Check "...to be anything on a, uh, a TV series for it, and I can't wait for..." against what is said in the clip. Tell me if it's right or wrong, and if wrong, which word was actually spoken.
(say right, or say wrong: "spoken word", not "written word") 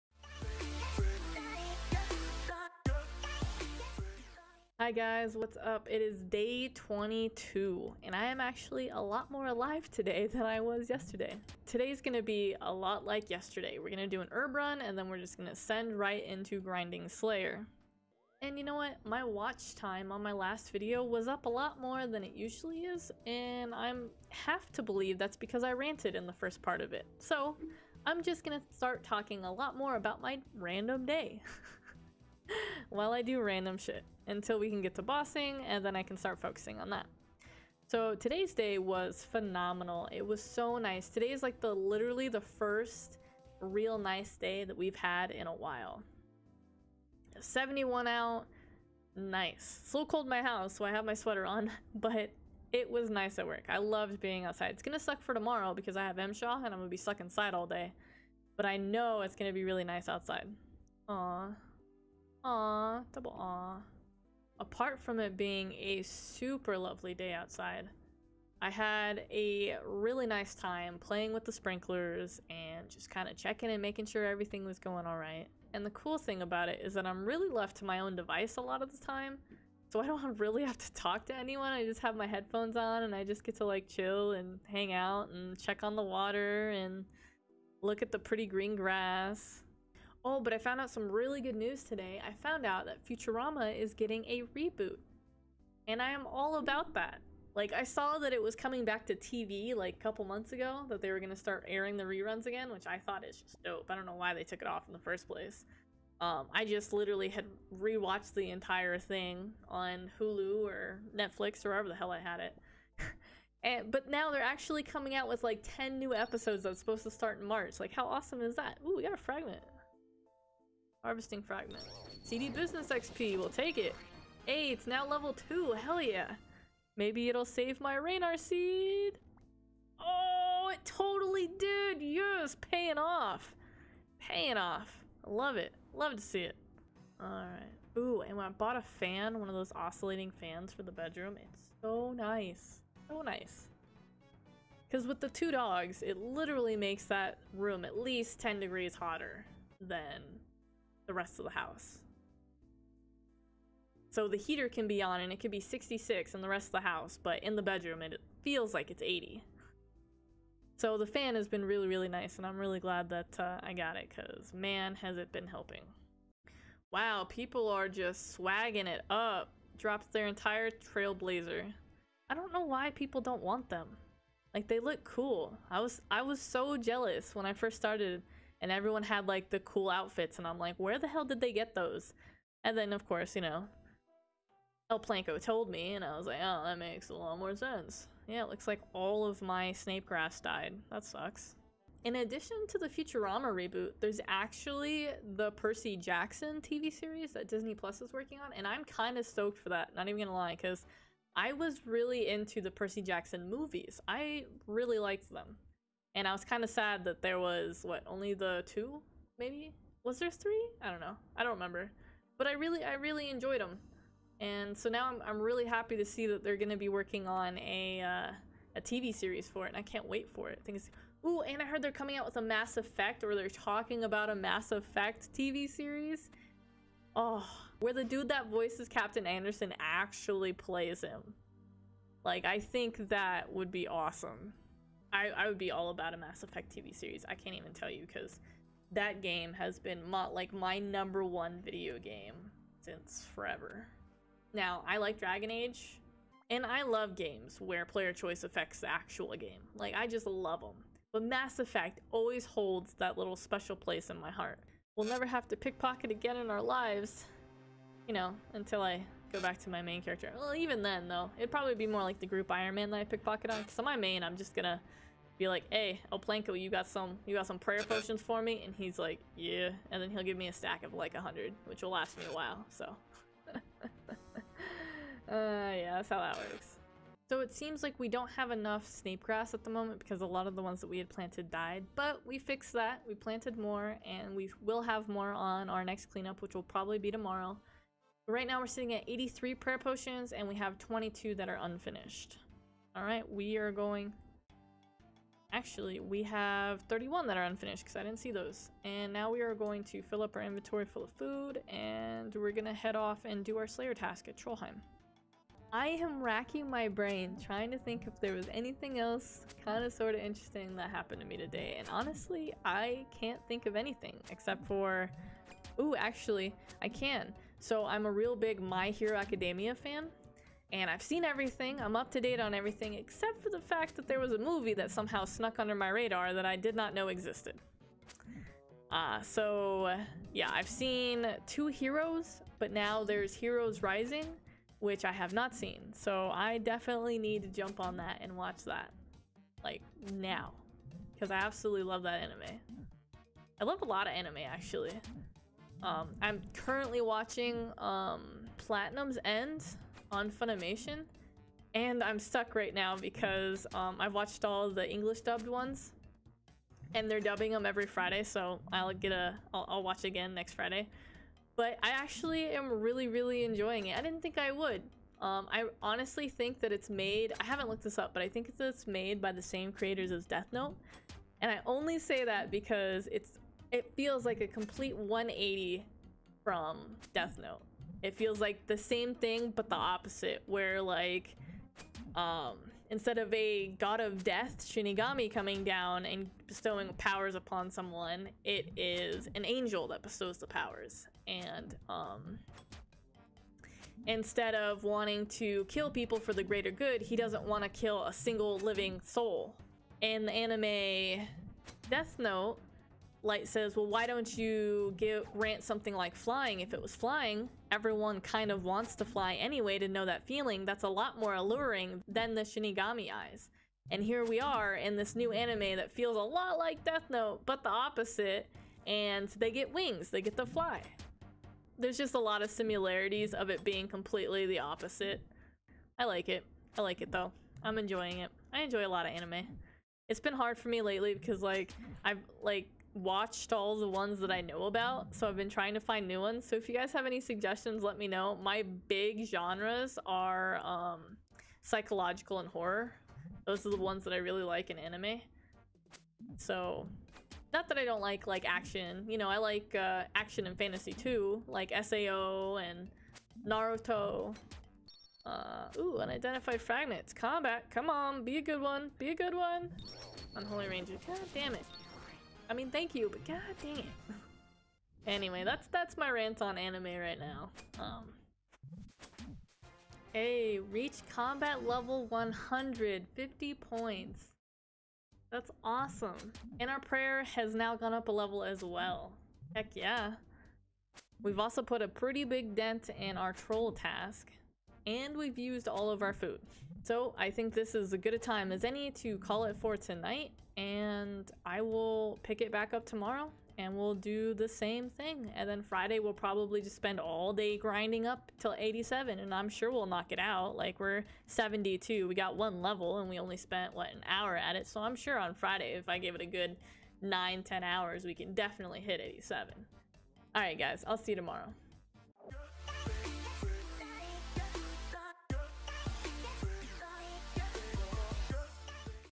wrong: "working", not "anything".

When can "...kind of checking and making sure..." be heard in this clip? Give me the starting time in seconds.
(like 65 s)
73 s.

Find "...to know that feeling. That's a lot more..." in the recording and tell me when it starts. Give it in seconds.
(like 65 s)
409 s.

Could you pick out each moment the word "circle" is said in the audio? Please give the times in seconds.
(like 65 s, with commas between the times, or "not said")
not said.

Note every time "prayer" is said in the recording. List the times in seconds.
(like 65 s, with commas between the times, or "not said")
267 s, 289 s, 476 s.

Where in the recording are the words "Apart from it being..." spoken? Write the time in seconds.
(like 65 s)
64 s.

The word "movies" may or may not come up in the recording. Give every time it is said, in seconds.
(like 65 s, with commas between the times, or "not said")
203 s, 324 s.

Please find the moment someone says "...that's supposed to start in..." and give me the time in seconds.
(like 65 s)
116 s.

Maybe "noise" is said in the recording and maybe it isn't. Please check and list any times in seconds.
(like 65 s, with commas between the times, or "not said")
not said.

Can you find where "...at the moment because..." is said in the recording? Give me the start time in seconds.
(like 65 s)
279 s.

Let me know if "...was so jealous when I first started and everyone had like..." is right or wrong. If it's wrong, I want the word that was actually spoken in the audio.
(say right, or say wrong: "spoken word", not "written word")
right.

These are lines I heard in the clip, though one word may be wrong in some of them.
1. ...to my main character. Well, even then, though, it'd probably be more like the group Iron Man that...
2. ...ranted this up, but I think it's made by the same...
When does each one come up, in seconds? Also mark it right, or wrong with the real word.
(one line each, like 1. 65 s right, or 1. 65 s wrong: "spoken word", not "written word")
1. 259 s right
2. 367 s wrong: "looked", not "ranted".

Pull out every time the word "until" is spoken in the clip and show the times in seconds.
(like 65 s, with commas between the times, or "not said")
34 s, 258 s.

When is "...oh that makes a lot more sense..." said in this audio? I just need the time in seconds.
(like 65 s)
186 s.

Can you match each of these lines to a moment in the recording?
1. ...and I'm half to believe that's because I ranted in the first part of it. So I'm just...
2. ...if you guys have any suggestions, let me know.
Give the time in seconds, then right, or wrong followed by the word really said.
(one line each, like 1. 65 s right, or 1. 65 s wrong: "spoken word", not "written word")
1. 23 s right
2. 436 s right.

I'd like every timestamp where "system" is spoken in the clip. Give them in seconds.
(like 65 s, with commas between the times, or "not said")
not said.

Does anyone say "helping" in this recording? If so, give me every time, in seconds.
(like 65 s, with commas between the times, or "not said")
165 s.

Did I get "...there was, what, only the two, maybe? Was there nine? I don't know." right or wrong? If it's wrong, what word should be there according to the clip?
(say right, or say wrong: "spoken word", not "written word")
wrong: "three", not "nine".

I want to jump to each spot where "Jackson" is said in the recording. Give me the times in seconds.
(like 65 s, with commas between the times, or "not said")
195 s, 203 s.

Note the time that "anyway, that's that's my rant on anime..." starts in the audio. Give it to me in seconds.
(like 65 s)
465 s.